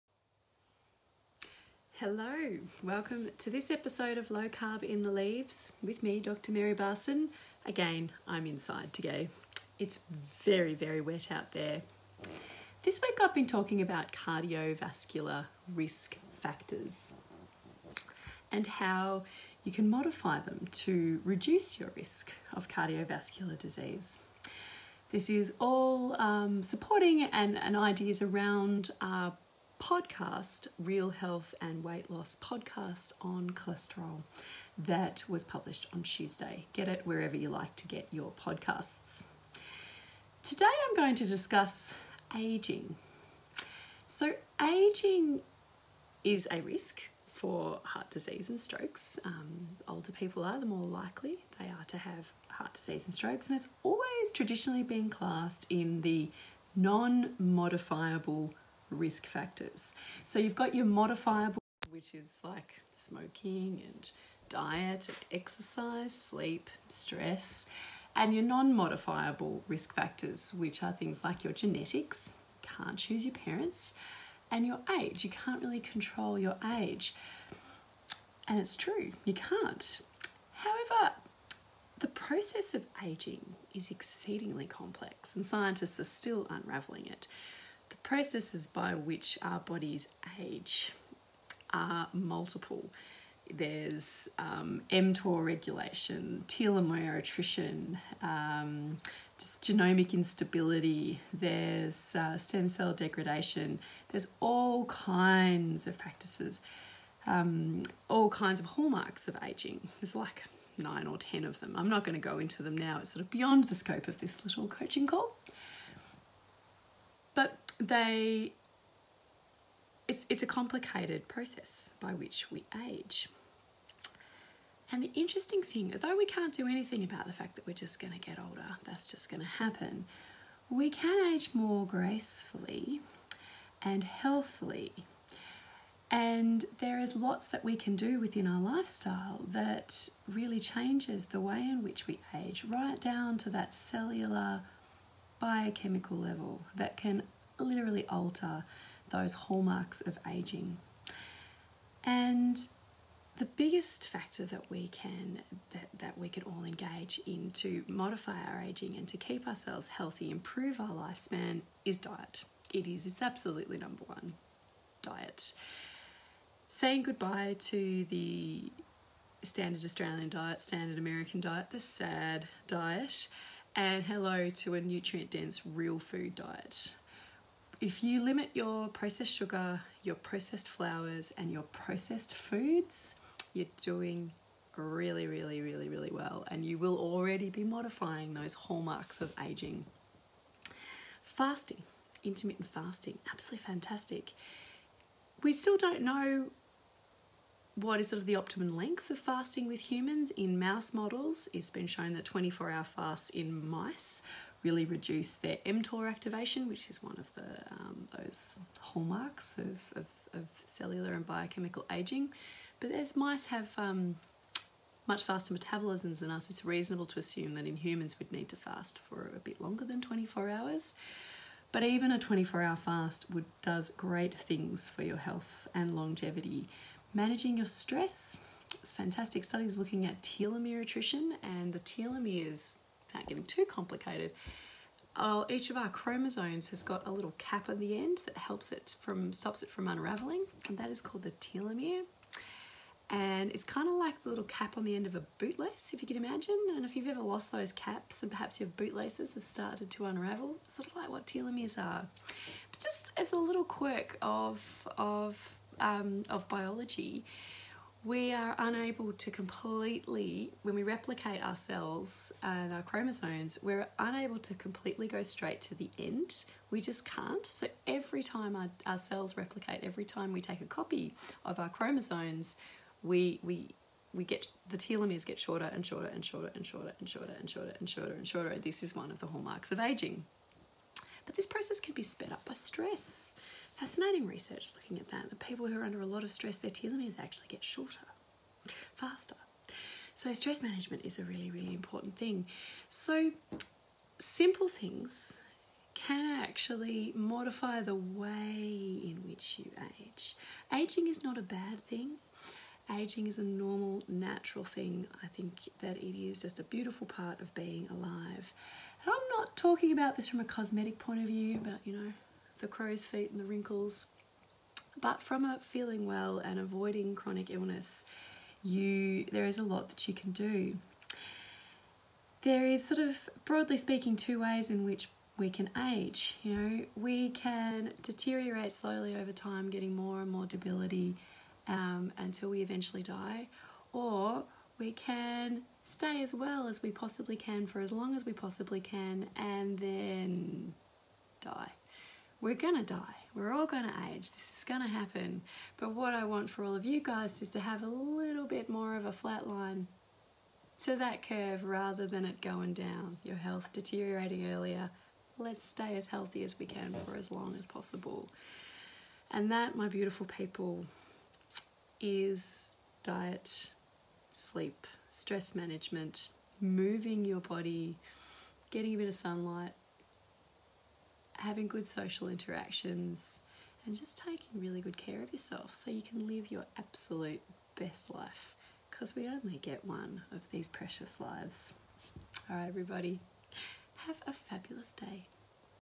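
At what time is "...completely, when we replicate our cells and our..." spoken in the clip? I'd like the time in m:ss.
4:19.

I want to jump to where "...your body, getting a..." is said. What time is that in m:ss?
6:07.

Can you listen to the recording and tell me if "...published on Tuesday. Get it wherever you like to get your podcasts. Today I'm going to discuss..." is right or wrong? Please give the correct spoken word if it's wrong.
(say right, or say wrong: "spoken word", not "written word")
right.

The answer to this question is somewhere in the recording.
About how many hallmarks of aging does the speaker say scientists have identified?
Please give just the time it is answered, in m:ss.
1:50.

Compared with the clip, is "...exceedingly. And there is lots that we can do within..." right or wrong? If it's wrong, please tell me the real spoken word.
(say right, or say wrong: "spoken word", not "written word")
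wrong: "healthily", not "exceedingly".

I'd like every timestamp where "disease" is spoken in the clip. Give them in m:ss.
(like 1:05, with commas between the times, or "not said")
0:23, 0:48, 0:52.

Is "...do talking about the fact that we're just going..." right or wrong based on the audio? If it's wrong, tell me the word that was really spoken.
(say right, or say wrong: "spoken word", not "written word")
wrong: "anything", not "talking".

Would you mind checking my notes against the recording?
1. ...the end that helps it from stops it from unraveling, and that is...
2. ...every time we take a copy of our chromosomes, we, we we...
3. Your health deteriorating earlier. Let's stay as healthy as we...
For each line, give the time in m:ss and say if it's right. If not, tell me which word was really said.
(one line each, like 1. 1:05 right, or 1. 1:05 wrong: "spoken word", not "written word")
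1. 3:57 right
2. 4:29 right
3. 5:53 right.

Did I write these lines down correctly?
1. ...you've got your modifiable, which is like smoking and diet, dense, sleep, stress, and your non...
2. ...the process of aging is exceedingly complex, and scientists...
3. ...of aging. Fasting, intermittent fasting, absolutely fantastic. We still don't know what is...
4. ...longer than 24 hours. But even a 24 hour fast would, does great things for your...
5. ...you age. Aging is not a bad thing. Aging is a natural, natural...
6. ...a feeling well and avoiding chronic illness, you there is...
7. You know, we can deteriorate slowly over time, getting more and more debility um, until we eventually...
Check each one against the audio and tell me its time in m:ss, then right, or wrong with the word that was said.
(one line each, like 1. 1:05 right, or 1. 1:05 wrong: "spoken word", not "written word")
1. 1:00 wrong: "exercise", not "dense"
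2. 1:21 right
3. 3:09 right
4. 3:39 right
5. 4:59 wrong: "normal", not "natural"
6. 5:15 right
7. 5:26 right.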